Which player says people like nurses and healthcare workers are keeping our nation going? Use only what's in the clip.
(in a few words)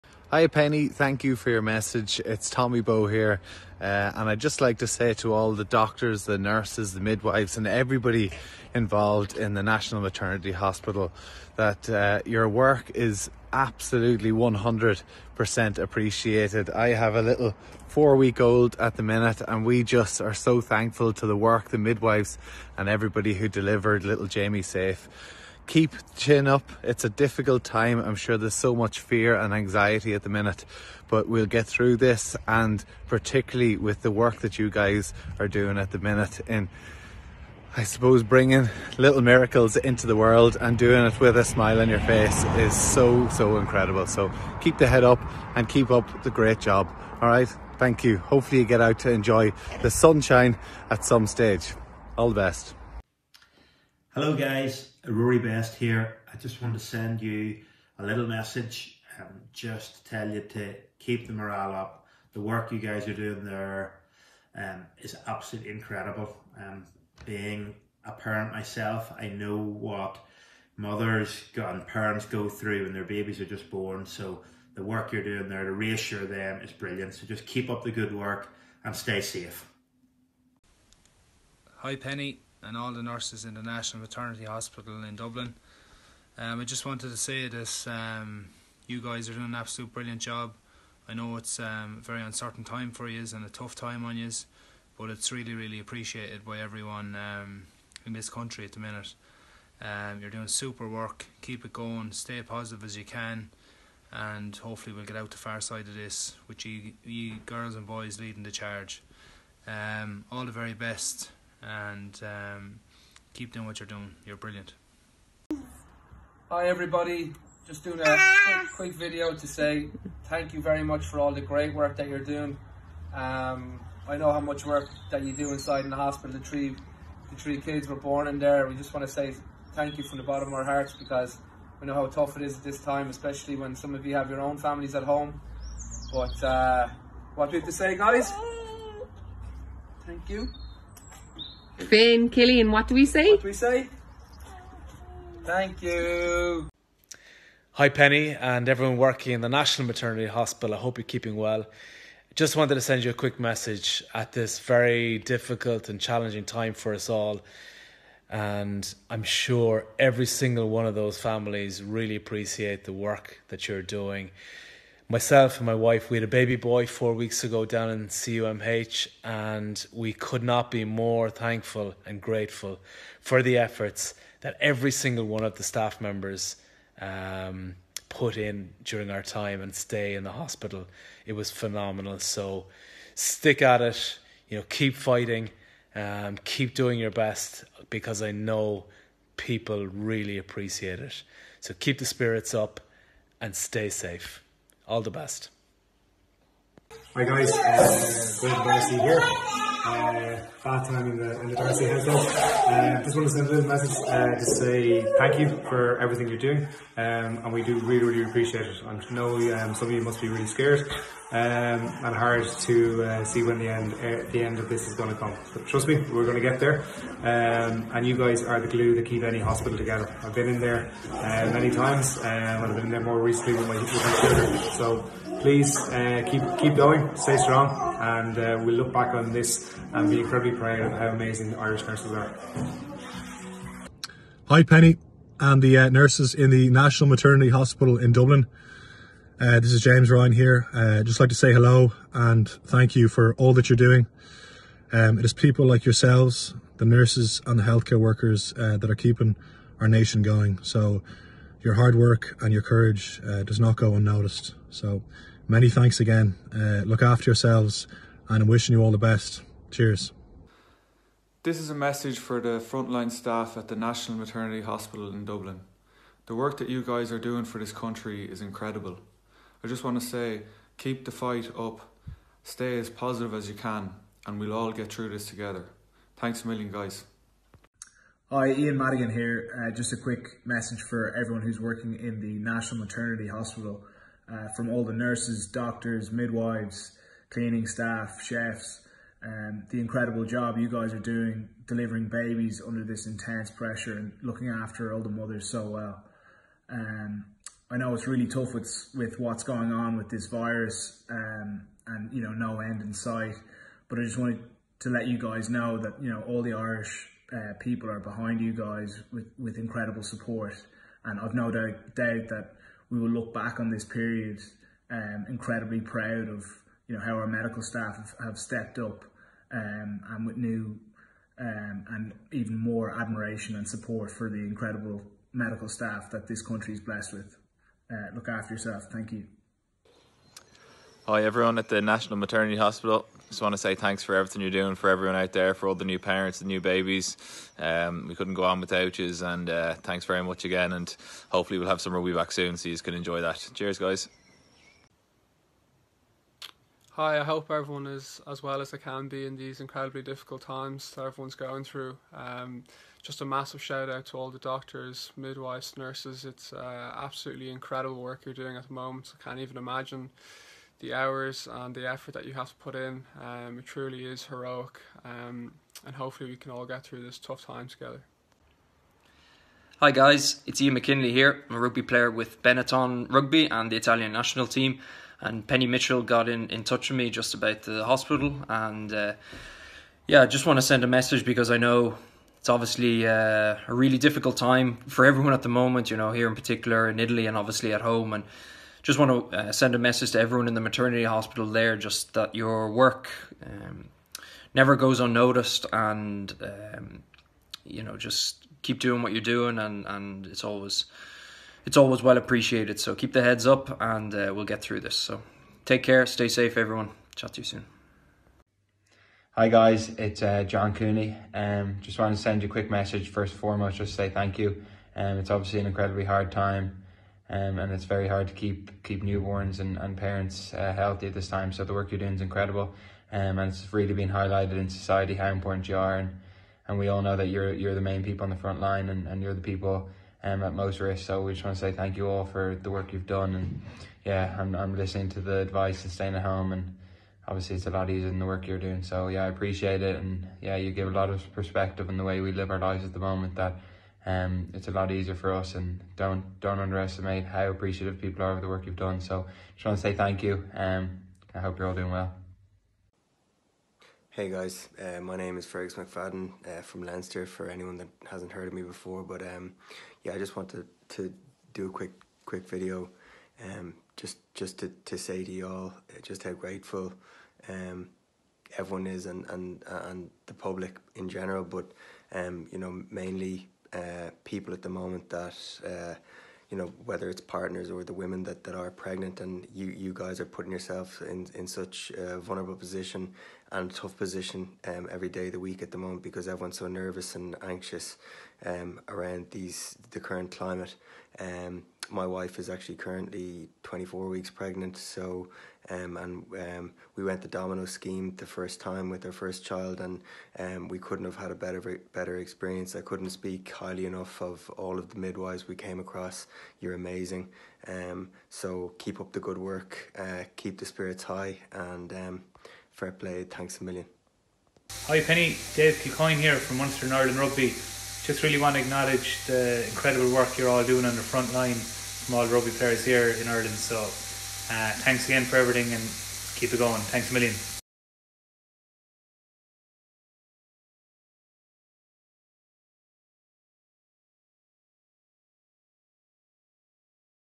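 James Ryan.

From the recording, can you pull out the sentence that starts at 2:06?
The three, the three kids were born in there.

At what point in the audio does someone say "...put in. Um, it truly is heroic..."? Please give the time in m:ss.
6:02.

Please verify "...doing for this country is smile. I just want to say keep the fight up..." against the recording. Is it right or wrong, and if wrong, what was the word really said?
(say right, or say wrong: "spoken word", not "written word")
wrong: "incredible", not "smile".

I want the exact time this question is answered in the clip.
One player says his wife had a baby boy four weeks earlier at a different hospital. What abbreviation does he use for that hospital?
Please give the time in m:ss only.
2:48.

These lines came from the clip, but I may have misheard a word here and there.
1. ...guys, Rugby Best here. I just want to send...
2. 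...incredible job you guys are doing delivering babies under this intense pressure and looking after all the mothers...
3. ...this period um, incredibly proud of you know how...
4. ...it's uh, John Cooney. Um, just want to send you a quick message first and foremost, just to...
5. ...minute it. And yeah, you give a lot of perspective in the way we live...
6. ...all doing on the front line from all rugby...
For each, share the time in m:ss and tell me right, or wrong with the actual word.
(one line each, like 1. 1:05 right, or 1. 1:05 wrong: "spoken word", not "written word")
1. 0:54 wrong: "Rory", not "Rugby"
2. 4:49 right
3. 5:13 right
4. 6:49 right
5. 7:19 wrong: "appreciate", not "minute"
6. 8:40 right.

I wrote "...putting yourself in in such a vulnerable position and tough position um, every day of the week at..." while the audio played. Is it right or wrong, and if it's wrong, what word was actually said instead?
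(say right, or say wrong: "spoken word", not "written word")
right.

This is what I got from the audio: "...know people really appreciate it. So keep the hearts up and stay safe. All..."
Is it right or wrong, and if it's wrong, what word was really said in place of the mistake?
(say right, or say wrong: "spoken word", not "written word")
wrong: "spirits", not "hearts".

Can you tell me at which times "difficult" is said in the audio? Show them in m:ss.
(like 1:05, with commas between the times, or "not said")
0:27, 2:35, 5:50, 6:23.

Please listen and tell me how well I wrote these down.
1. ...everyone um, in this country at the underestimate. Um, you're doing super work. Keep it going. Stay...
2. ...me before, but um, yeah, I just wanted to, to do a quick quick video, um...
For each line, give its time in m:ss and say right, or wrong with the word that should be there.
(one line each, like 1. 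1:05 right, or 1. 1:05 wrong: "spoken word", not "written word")
1. 1:36 wrong: "minute", not "underestimate"
2. 7:38 right.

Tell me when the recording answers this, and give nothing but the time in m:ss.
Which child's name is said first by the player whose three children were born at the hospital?
2:21.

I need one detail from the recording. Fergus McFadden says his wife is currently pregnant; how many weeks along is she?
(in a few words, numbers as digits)
24.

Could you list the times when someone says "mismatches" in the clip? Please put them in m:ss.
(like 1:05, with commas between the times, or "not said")
not said.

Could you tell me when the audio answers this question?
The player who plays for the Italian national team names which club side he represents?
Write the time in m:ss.
6:12.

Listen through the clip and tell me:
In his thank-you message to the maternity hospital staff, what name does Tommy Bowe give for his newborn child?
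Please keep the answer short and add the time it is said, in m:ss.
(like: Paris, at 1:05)
Jamie, at 0:24.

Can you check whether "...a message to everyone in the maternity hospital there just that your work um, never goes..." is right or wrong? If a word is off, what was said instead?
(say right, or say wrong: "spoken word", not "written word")
right.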